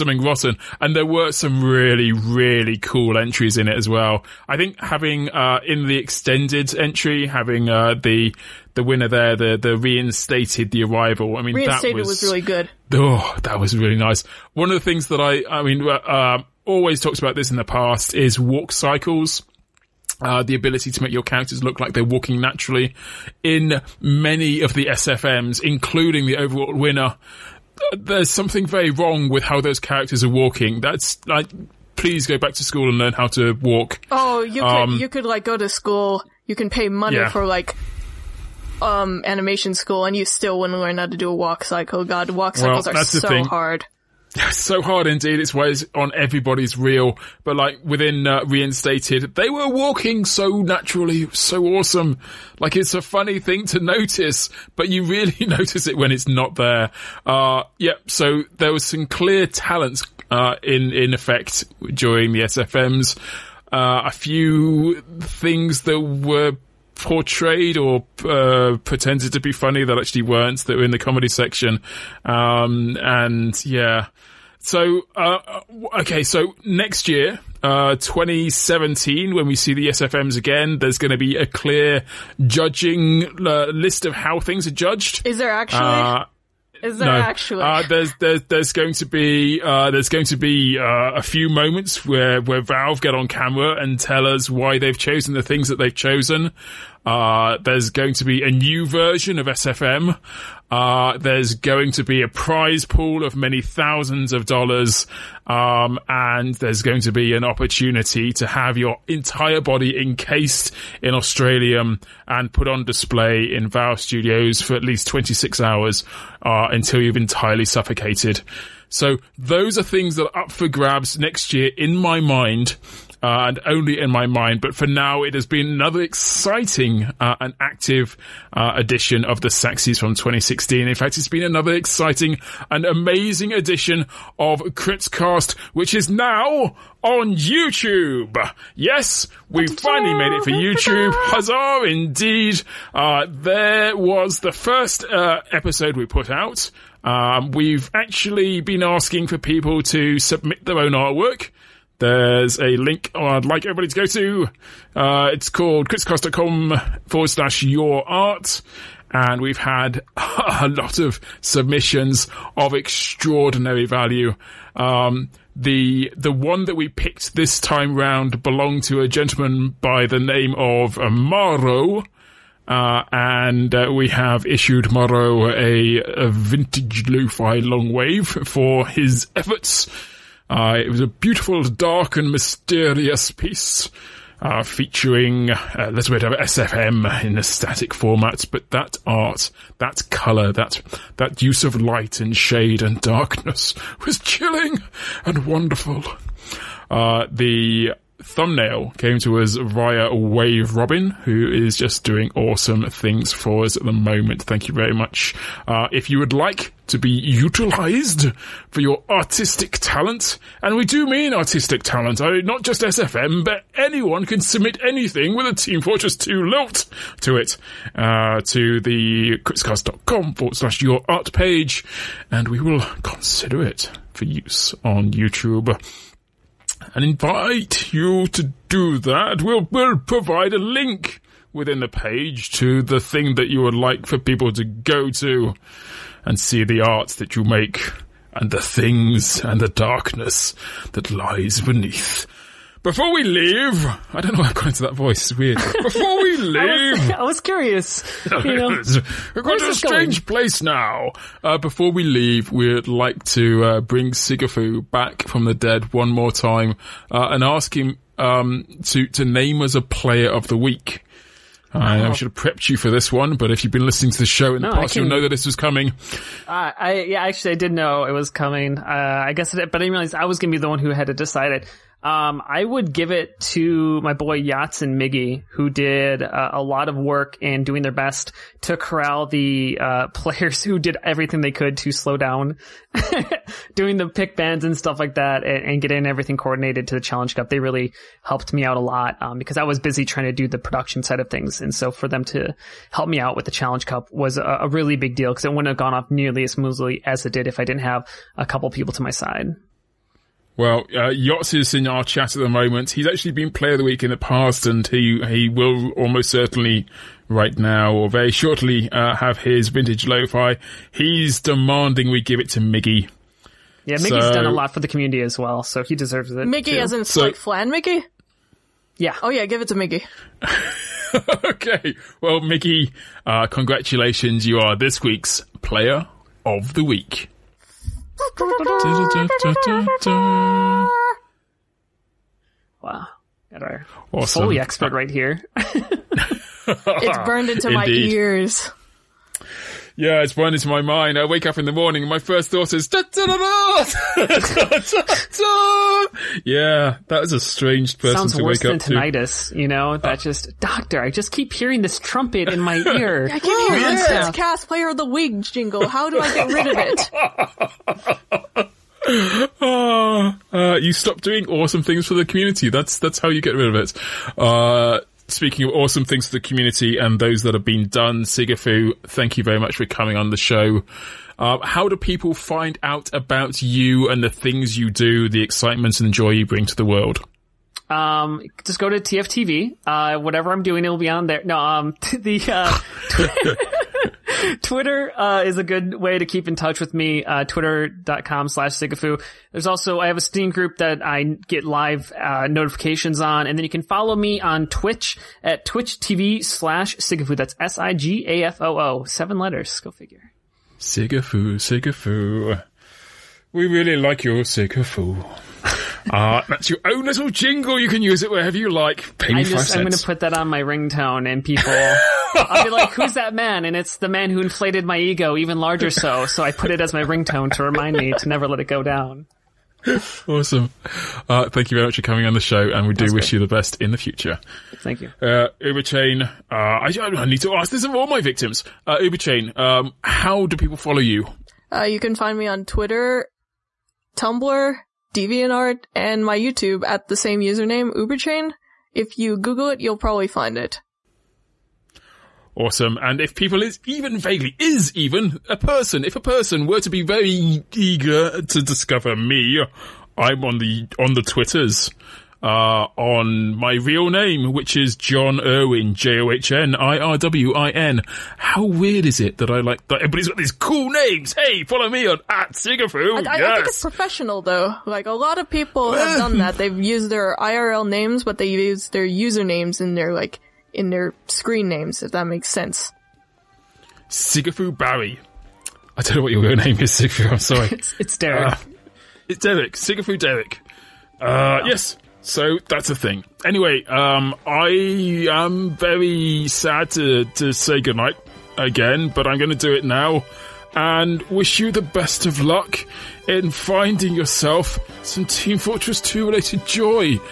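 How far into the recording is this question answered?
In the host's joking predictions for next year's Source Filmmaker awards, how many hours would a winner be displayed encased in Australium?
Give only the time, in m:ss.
1:55.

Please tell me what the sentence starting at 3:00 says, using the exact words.
Uh, it was a beautiful, dark, and mysterious piece.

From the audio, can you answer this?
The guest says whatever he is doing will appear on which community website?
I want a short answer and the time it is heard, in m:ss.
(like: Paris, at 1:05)
TFTV, at 6:18.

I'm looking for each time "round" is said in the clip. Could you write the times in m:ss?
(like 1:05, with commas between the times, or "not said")
2:47.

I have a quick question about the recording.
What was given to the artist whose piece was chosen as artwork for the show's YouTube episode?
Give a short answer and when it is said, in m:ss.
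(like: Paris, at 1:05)
Vintage lo-fi long wave, at 2:56.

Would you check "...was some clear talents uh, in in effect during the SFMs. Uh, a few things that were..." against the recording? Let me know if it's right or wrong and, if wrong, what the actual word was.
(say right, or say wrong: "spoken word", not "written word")
right.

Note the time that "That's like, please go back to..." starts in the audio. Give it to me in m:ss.
0:30.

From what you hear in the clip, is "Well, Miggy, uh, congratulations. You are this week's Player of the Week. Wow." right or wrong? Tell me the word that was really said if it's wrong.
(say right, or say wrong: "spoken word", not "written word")
right.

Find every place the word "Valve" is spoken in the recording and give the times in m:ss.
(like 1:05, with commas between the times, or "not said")
1:32, 1:53.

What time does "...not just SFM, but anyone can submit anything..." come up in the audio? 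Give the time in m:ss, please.
3:32.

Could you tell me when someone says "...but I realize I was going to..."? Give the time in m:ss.
4:29.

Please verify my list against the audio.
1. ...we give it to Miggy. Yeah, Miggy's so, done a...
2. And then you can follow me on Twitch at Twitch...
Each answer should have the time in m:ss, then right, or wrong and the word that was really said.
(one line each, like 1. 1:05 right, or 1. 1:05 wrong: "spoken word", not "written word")
1. 5:12 right
2. 6:33 right.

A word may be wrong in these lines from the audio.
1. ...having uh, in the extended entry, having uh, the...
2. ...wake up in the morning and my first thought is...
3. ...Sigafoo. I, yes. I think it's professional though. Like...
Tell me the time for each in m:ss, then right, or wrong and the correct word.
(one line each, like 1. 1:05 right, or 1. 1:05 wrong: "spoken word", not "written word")
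1. 0:04 right
2. 5:41 right
3. 7:42 right.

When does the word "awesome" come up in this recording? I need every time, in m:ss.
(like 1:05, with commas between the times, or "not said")
0:51, 3:22, 5:34, 6:01, 6:05, 7:00, 7:22.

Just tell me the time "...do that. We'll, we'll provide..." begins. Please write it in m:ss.
3:48.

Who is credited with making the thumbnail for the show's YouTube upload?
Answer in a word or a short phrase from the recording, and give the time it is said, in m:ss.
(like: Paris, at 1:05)
WaveRobin, at 3:20.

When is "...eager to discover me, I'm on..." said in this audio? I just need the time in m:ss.
7:27.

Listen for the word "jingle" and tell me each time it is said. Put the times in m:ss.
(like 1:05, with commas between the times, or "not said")
5:55, 6:47.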